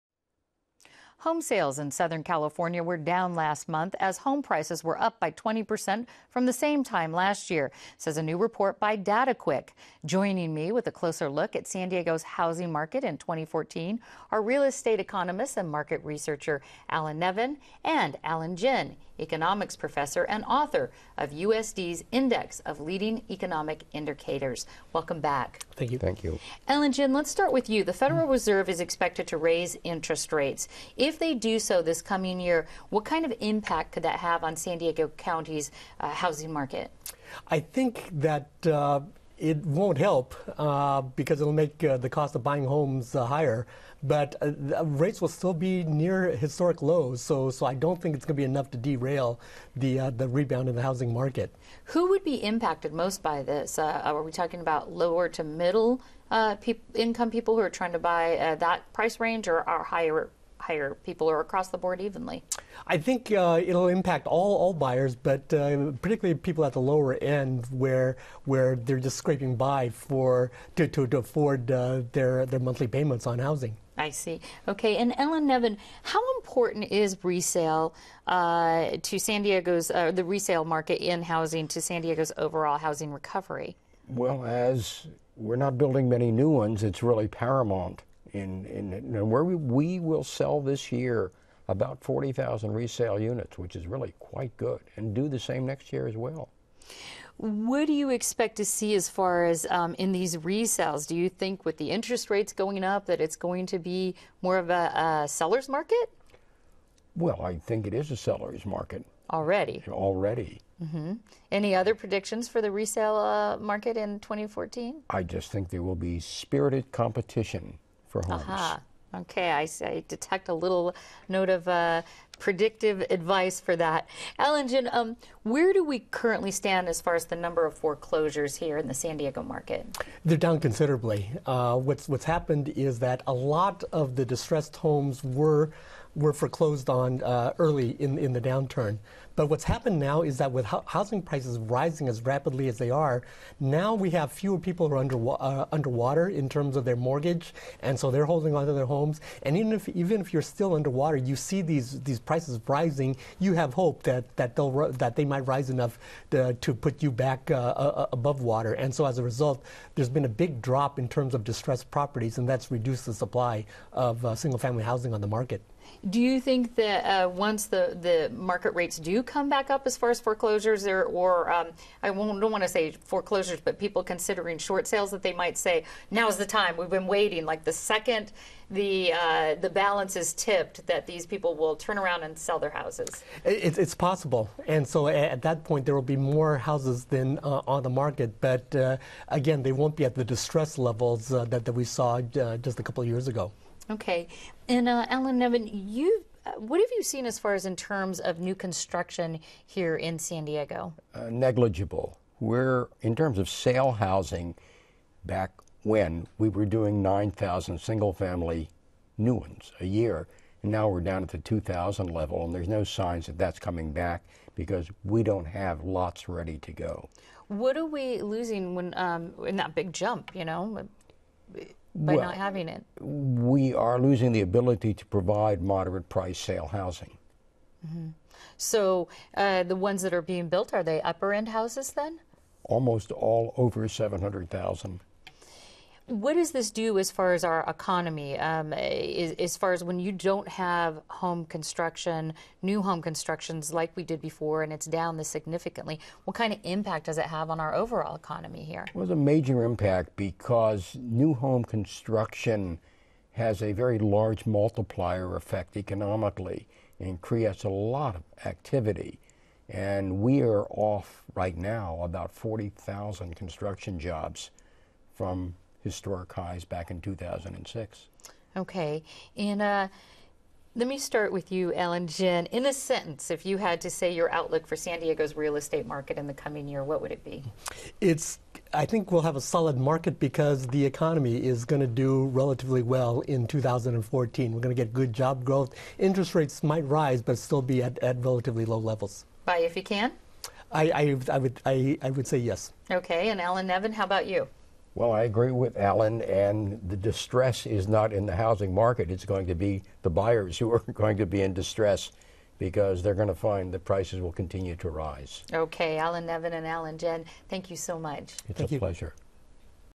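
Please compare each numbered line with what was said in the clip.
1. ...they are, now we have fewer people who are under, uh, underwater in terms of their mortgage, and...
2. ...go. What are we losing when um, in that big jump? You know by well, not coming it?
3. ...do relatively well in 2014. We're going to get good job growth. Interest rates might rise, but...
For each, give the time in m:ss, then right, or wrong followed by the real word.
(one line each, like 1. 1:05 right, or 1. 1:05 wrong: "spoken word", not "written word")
1. 2:22 right
2. 3:36 wrong: "having", not "coming"
3. 4:41 right.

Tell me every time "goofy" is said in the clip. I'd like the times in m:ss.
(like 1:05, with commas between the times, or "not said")
not said.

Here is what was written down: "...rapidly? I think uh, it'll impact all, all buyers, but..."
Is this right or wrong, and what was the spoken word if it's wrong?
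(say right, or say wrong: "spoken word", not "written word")
wrong: "evenly", not "rapidly".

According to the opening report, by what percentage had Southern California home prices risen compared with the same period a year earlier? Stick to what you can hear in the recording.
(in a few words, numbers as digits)
20%.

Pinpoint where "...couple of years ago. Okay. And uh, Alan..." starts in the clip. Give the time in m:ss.
3:12.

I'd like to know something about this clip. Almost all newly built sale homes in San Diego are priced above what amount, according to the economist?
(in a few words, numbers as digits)
700,000.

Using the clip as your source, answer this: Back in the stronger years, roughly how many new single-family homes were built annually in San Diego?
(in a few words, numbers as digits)
9,000.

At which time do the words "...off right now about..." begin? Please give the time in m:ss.
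4:20.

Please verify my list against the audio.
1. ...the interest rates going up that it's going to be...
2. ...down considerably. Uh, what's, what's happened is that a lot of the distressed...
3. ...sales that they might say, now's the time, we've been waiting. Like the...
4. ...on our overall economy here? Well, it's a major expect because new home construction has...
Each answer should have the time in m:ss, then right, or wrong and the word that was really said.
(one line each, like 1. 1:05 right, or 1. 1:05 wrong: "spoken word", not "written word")
1. 1:41 right
2. 2:10 right
3. 2:54 right
4. 4:07 wrong: "impact", not "expect".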